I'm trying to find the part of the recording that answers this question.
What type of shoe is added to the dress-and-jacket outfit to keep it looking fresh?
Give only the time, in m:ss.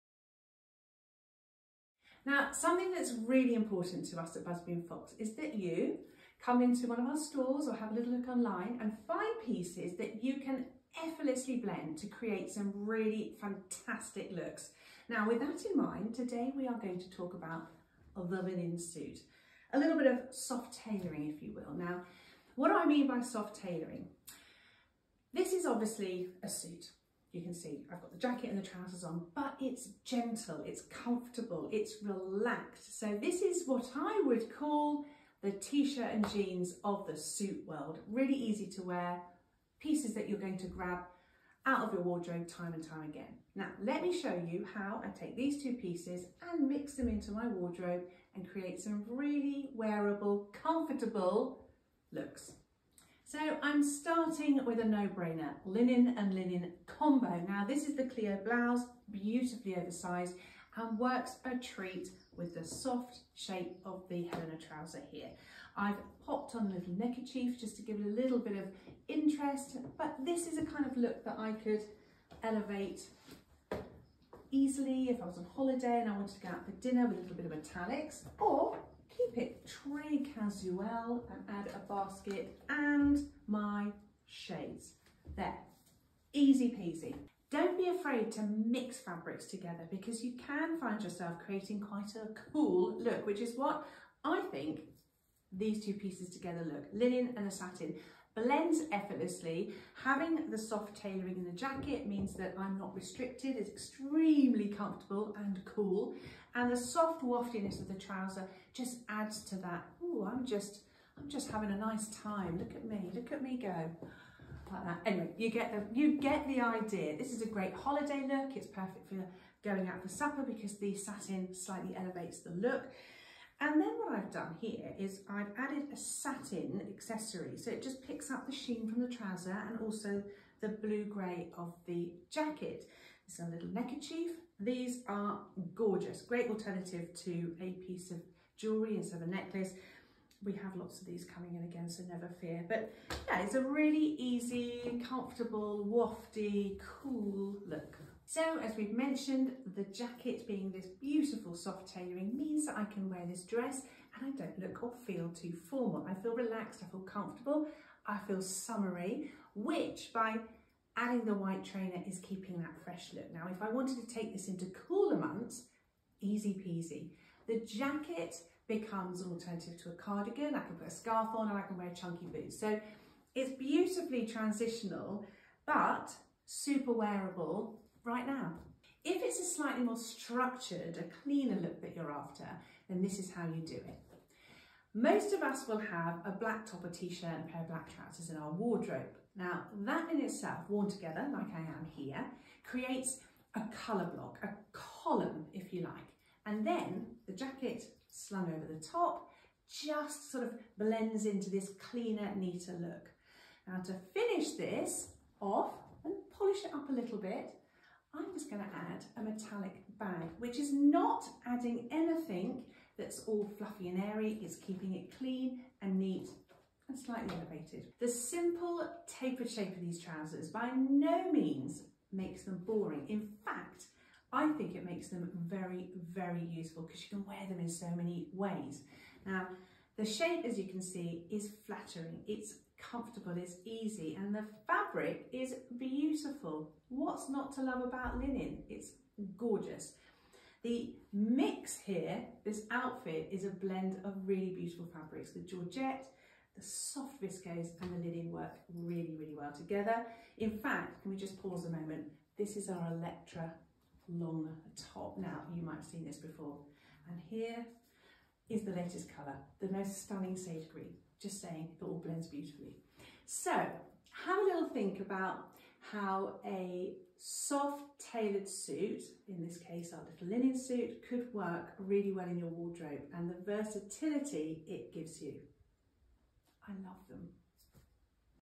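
2:41.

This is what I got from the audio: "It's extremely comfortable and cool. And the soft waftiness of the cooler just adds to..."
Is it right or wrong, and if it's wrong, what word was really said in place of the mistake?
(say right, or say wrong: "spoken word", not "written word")
wrong: "trouser", not "cooler".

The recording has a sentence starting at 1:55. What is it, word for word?
Anyway, you get the, you get the idea.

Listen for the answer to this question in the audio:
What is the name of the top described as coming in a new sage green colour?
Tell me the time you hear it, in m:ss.
4:12.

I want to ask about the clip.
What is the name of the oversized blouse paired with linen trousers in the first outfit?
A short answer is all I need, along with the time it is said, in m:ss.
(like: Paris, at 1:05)
Clio blouse, at 0:58.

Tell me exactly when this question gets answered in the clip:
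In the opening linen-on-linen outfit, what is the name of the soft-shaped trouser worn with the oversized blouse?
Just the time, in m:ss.
1:04.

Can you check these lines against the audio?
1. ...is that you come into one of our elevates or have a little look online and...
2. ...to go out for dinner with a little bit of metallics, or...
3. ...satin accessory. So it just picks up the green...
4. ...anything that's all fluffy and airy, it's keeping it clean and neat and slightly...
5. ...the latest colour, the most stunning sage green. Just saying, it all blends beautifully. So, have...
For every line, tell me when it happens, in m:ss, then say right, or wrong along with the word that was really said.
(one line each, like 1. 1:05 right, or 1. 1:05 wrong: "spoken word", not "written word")
1. 0:05 wrong: "stores", not "elevates"
2. 1:16 right
3. 2:05 wrong: "sheen", not "green"
4. 3:31 right
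5. 4:18 right.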